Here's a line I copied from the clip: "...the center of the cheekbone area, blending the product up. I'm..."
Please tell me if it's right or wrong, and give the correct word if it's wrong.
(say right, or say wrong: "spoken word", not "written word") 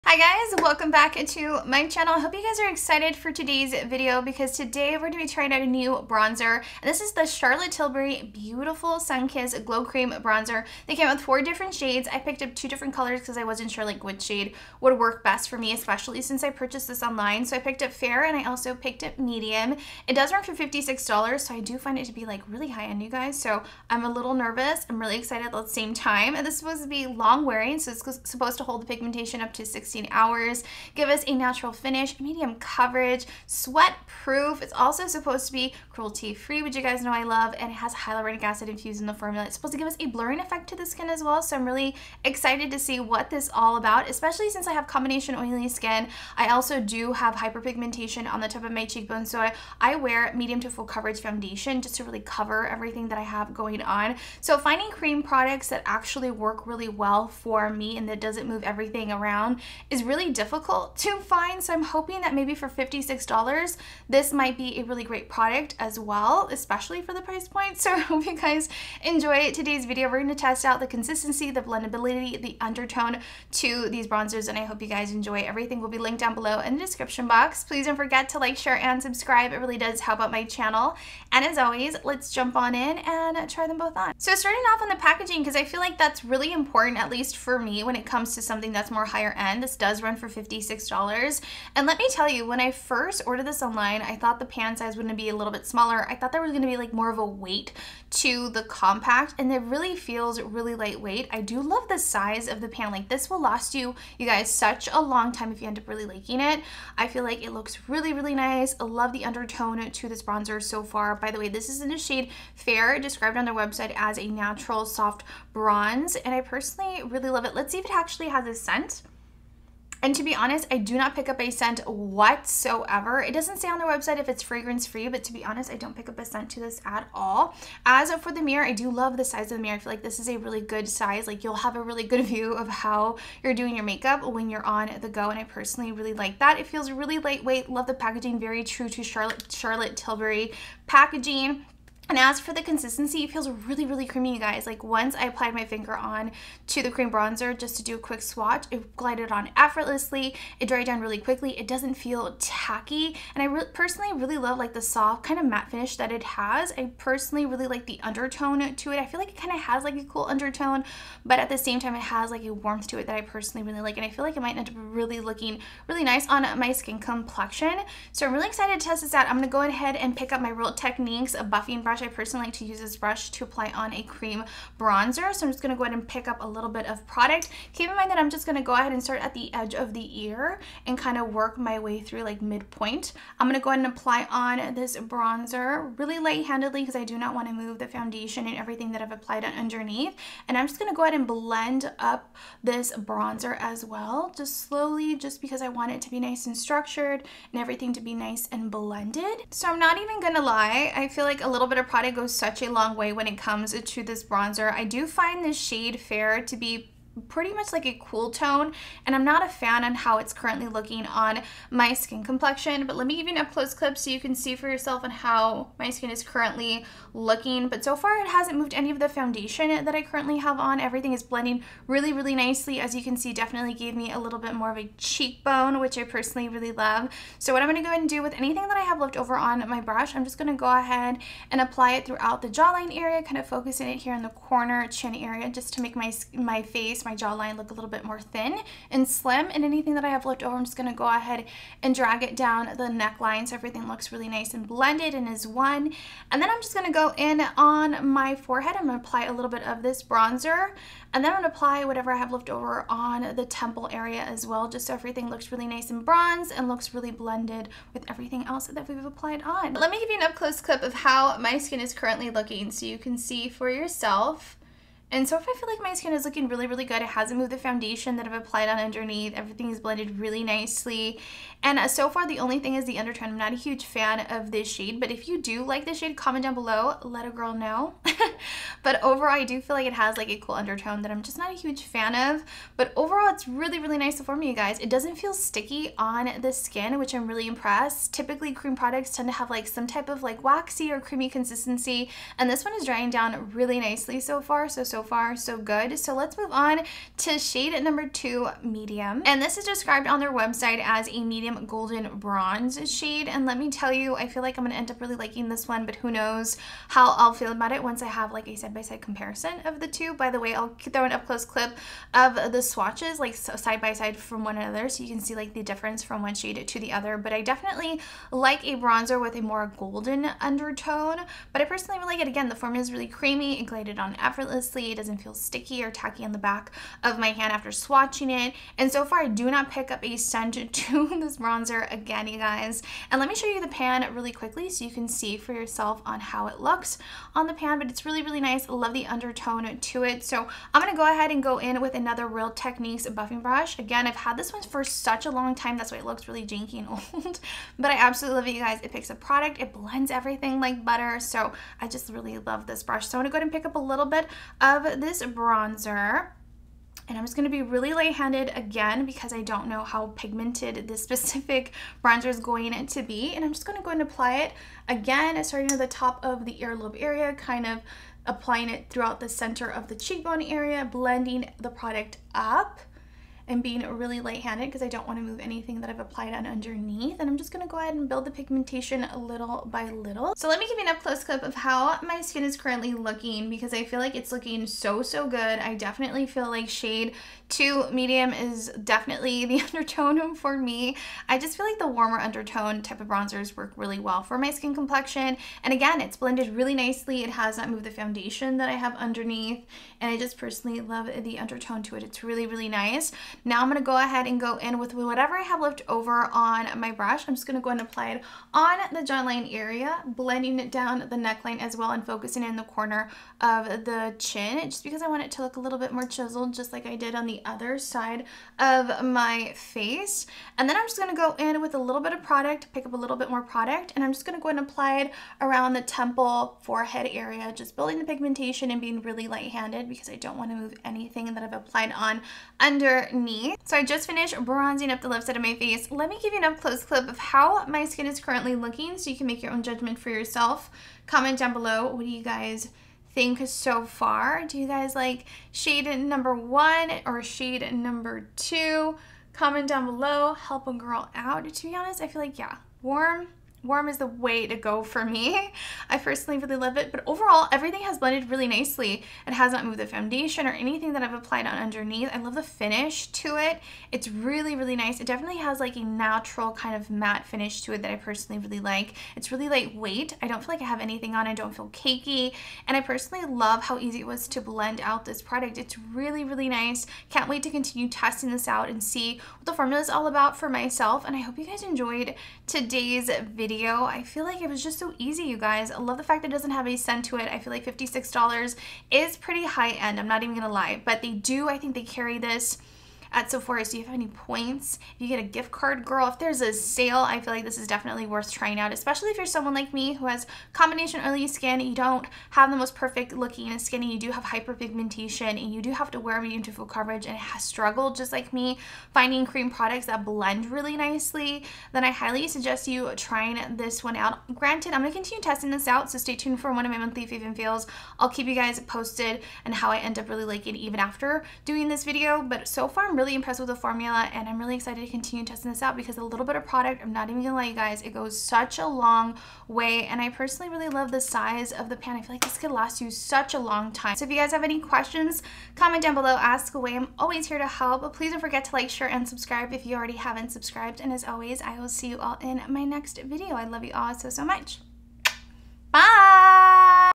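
right.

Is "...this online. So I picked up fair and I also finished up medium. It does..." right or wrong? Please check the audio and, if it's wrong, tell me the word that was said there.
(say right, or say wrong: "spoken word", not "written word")
wrong: "picked", not "finished".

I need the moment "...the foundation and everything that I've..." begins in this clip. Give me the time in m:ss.
3:07.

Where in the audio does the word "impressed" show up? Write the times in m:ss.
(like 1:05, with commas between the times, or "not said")
4:47, 8:43.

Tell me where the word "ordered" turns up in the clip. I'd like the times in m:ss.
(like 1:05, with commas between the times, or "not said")
1:33.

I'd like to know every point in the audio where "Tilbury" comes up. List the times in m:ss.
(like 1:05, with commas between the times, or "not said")
0:07, 2:19.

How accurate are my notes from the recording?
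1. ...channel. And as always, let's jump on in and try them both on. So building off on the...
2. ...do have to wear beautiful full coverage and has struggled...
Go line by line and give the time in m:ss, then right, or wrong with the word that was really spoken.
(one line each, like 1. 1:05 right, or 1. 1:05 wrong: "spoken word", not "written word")
1. 1:20 wrong: "starting", not "building"
2. 8:25 right.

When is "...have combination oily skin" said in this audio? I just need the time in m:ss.
0:44.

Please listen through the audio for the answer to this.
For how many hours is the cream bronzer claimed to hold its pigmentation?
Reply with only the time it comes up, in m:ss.
0:29.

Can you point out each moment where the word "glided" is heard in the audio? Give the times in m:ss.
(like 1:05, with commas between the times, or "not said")
2:28, 5:23.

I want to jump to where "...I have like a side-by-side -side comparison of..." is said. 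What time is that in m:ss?
5:08.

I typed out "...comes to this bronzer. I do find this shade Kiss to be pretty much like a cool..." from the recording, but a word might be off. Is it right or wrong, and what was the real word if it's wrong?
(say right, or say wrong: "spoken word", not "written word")
wrong: "Fair", not "Kiss".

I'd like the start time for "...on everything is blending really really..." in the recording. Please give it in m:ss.
3:40.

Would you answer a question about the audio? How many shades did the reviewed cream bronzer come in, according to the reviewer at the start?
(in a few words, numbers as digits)
4.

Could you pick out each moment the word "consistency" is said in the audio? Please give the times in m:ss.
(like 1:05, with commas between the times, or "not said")
1:10, 2:22, 4:51.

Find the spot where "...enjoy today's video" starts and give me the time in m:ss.
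1:09.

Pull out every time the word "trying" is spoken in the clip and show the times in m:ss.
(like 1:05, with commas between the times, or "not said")
0:05, 8:18, 8:32.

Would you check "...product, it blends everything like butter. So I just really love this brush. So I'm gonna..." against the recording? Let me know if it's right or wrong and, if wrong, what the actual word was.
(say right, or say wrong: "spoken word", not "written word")
right.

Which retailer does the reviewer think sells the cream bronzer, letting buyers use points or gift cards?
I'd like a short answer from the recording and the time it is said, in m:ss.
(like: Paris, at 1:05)
Sephora, at 8:13.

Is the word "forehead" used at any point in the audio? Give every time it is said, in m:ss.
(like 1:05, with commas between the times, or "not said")
4:08, 7:06.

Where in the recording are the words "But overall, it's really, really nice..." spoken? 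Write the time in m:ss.
4:42.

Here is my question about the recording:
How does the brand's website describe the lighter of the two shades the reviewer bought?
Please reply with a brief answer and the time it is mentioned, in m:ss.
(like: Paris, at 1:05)
Natural soft bronze, at 1:54.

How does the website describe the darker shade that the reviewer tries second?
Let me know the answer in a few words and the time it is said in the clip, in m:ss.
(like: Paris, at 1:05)
Medium golden bronze, at 5:01.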